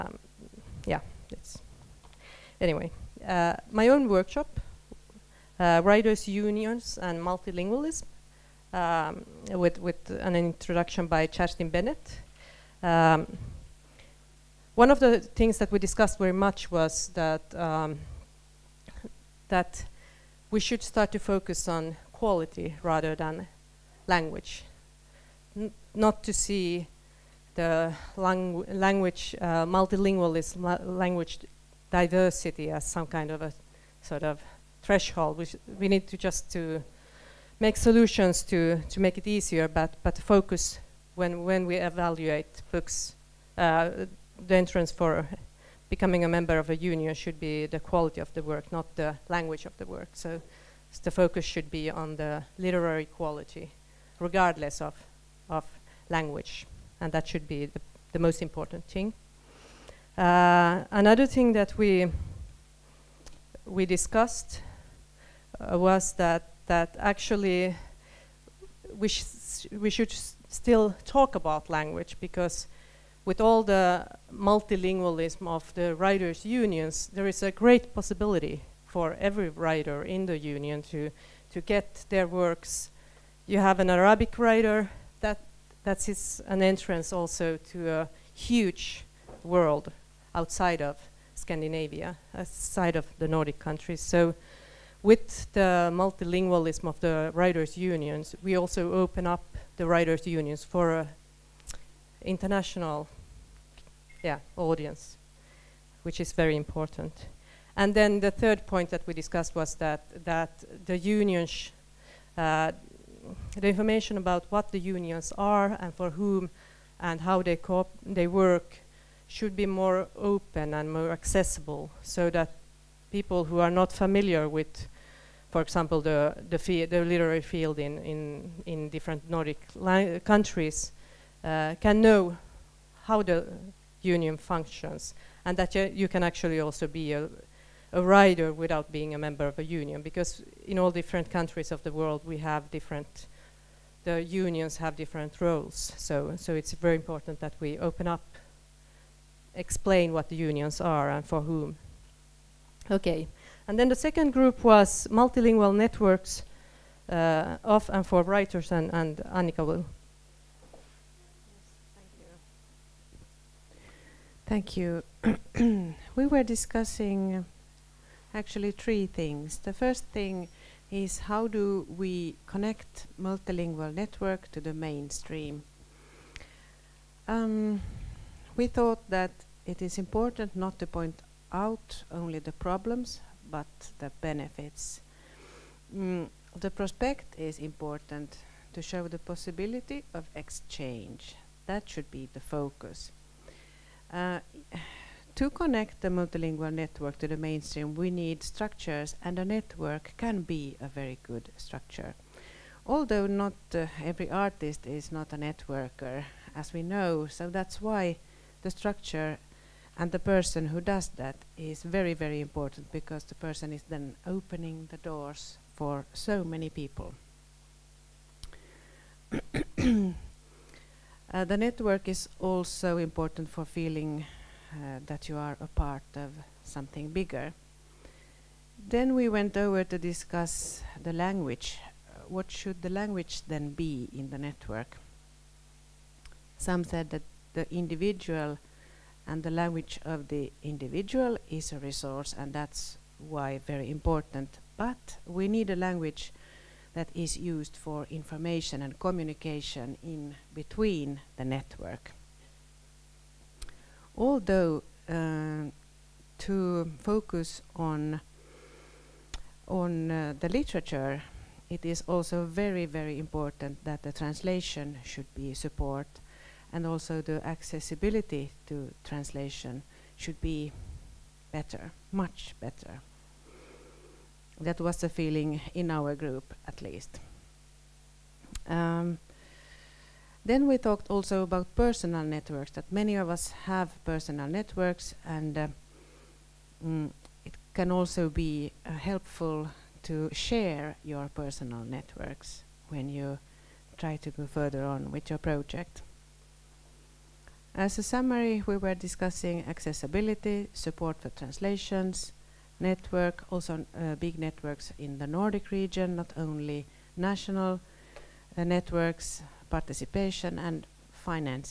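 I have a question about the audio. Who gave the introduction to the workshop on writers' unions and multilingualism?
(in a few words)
Kerstin Bennett.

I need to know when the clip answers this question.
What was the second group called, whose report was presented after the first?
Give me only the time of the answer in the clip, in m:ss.
2:35.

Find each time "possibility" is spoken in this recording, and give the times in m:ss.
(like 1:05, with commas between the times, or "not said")
1:17, 3:09.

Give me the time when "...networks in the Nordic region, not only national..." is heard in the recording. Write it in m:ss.
5:04.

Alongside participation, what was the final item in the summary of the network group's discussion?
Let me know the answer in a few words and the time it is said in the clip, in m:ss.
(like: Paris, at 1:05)
Financing, at 5:11.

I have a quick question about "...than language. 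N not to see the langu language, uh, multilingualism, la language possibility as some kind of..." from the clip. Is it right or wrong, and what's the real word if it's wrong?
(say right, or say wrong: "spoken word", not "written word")
wrong: "diversity", not "possibility".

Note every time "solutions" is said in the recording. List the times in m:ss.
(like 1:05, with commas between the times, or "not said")
0:37.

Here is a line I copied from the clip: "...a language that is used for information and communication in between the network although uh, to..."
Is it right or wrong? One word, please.
right.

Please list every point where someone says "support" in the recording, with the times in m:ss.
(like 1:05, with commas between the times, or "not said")
4:25, 5:00.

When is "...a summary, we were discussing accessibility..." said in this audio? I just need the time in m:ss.
4:57.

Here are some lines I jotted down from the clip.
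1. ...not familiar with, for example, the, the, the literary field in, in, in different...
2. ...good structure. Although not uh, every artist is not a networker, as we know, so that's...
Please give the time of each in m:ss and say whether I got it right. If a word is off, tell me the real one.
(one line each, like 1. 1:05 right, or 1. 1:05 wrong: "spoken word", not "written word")
1. 2:03 right
2. 3:21 right.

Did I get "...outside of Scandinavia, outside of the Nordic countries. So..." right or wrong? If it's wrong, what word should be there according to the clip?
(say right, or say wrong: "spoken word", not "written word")
right.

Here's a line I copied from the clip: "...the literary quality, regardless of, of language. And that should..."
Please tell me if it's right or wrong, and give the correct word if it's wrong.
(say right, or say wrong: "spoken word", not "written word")
right.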